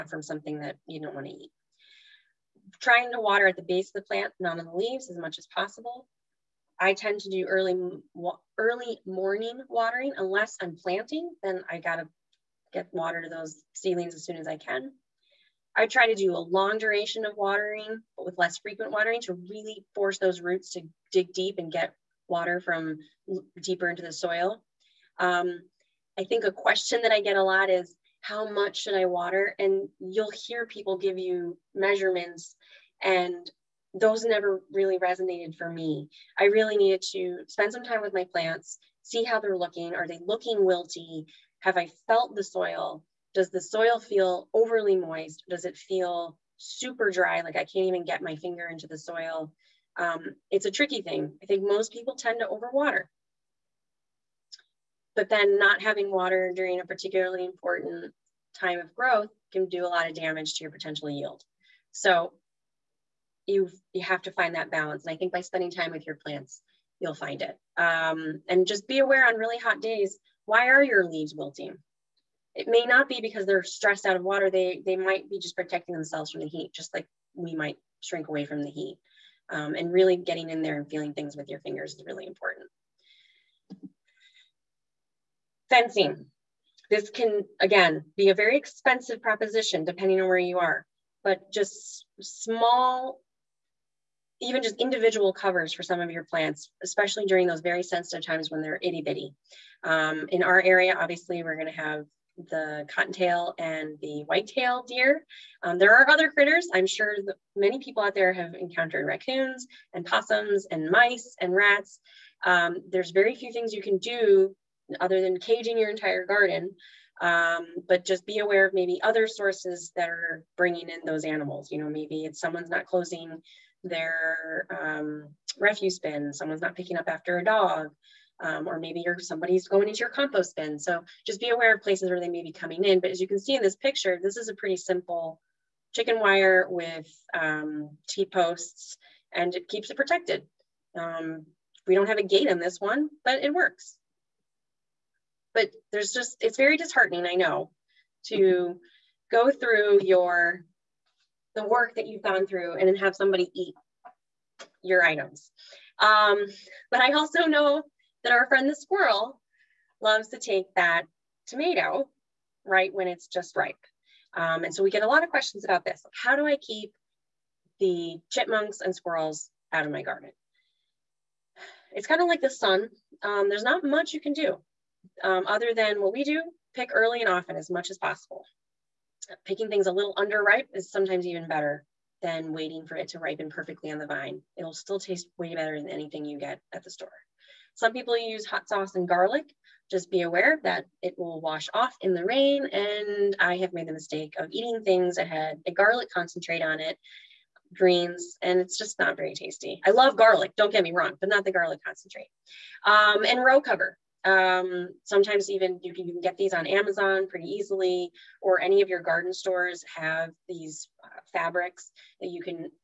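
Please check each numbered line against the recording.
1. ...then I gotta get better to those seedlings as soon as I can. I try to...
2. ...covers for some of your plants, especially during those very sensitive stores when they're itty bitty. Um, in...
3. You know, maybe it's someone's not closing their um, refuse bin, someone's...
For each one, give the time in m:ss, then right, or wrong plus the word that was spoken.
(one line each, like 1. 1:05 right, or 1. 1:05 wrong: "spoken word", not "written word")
1. 0:11 wrong: "water", not "better"
2. 1:35 wrong: "times", not "stores"
3. 2:01 right.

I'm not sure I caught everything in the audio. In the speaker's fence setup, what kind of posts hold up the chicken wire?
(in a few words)
T-posts.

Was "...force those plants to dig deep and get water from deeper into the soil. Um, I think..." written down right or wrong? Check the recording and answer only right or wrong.
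wrong.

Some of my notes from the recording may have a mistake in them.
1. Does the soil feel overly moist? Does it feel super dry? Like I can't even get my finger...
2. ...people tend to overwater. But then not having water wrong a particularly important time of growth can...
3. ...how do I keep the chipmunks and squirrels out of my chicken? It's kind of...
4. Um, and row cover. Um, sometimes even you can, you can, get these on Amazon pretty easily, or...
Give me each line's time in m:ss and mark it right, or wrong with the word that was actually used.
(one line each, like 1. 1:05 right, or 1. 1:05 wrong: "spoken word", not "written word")
1. 0:43 right
2. 0:51 wrong: "during", not "wrong"
3. 2:46 wrong: "garden", not "chicken"
4. 3:22 right.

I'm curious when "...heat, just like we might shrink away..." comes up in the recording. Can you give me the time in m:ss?
1:16.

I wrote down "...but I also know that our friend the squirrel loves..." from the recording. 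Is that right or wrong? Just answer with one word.
right.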